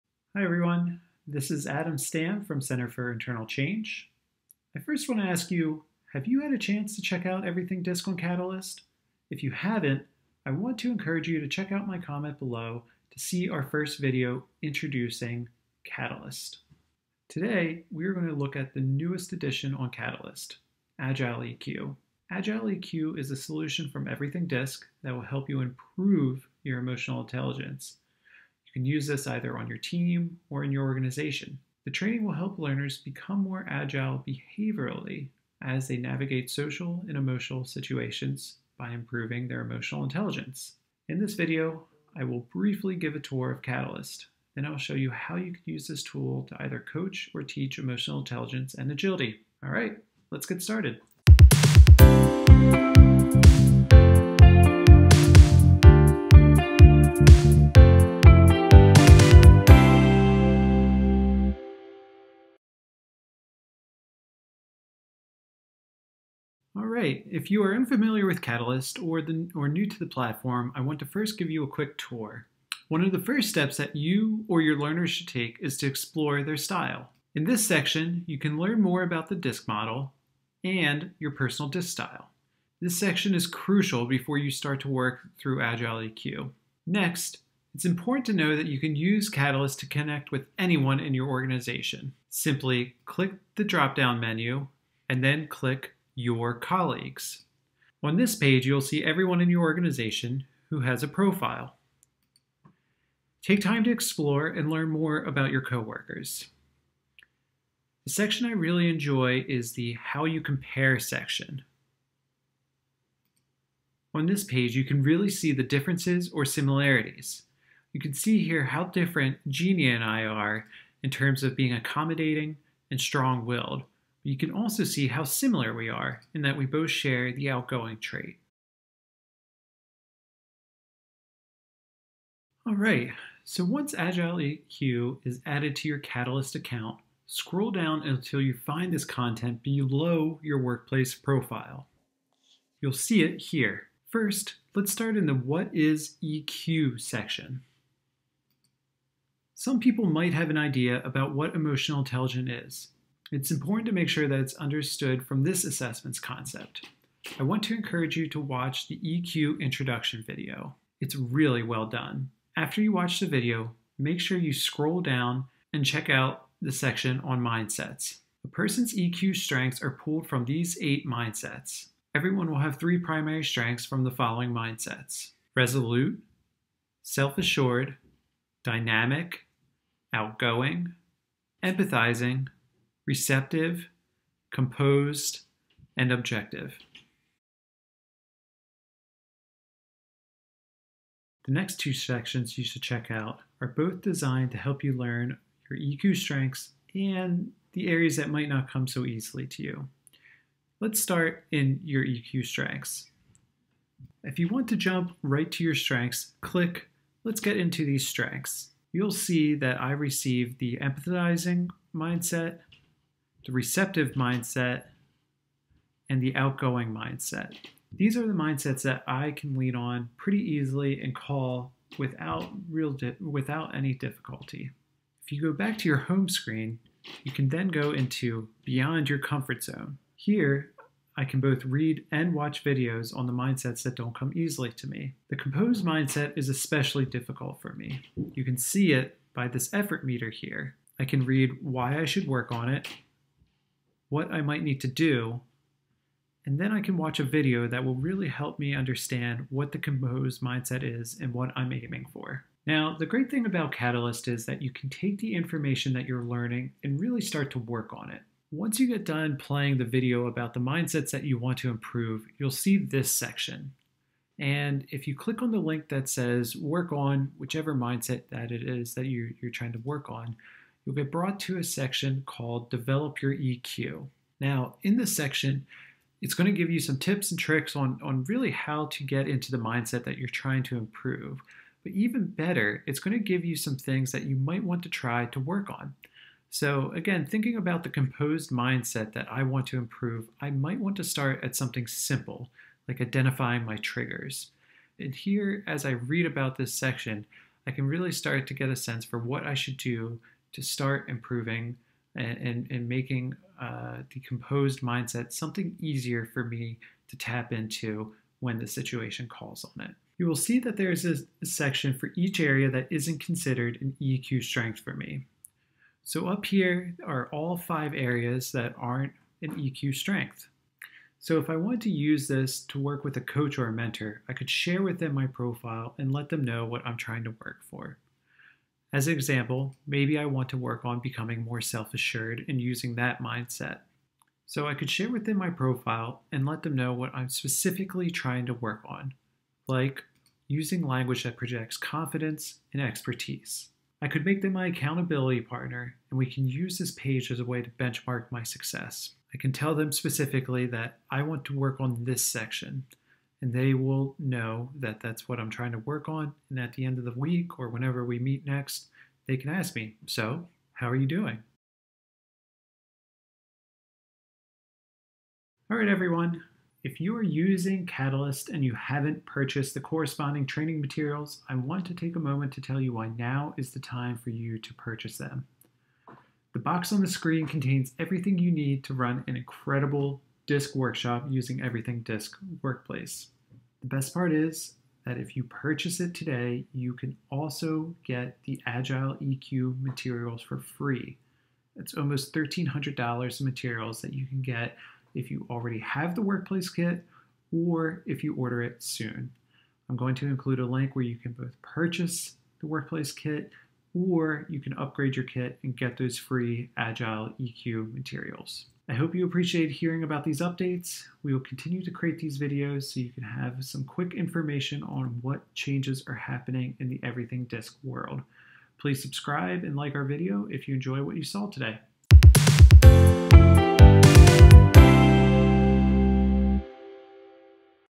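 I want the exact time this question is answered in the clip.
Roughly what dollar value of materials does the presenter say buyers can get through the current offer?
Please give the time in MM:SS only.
06:32.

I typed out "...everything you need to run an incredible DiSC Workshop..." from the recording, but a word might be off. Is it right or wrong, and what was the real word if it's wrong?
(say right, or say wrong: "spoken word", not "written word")
right.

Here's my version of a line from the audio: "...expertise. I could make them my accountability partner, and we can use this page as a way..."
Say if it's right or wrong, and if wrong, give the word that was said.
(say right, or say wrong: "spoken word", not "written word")
right.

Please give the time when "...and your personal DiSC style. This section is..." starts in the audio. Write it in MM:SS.
01:20.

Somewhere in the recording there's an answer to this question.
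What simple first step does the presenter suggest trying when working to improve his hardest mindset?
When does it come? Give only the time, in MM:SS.
04:53.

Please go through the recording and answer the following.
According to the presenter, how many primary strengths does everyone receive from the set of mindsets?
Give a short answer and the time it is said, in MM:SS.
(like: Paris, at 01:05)
3, at 02:52.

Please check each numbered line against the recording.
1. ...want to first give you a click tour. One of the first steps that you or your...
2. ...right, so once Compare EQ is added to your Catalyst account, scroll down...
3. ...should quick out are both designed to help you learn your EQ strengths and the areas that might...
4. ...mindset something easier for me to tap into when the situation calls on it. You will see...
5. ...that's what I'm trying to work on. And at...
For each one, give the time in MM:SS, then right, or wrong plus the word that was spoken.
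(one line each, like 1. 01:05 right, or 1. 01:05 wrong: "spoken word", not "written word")
1. 01:10 wrong: "quick", not "click"
2. 02:12 wrong: "Agile", not "Compare"
3. 03:12 wrong: "check", not "quick"
4. 05:04 right
5. 05:54 right.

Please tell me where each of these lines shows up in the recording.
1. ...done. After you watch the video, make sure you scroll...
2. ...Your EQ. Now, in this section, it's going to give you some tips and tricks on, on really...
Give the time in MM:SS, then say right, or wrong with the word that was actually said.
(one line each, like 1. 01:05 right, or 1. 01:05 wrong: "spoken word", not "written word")
1. 02:41 right
2. 04:33 right.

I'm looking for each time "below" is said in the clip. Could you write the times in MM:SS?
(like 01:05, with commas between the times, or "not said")
00:12, 02:19.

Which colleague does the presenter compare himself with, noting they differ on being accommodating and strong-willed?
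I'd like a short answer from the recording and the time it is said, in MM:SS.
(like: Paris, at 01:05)
Genie, at 01:59.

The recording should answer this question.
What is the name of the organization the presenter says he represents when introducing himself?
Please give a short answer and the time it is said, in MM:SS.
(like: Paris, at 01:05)
Center for Internal Change, at 00:02.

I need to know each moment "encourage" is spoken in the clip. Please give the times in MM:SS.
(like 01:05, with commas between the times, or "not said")
00:10, 02:37.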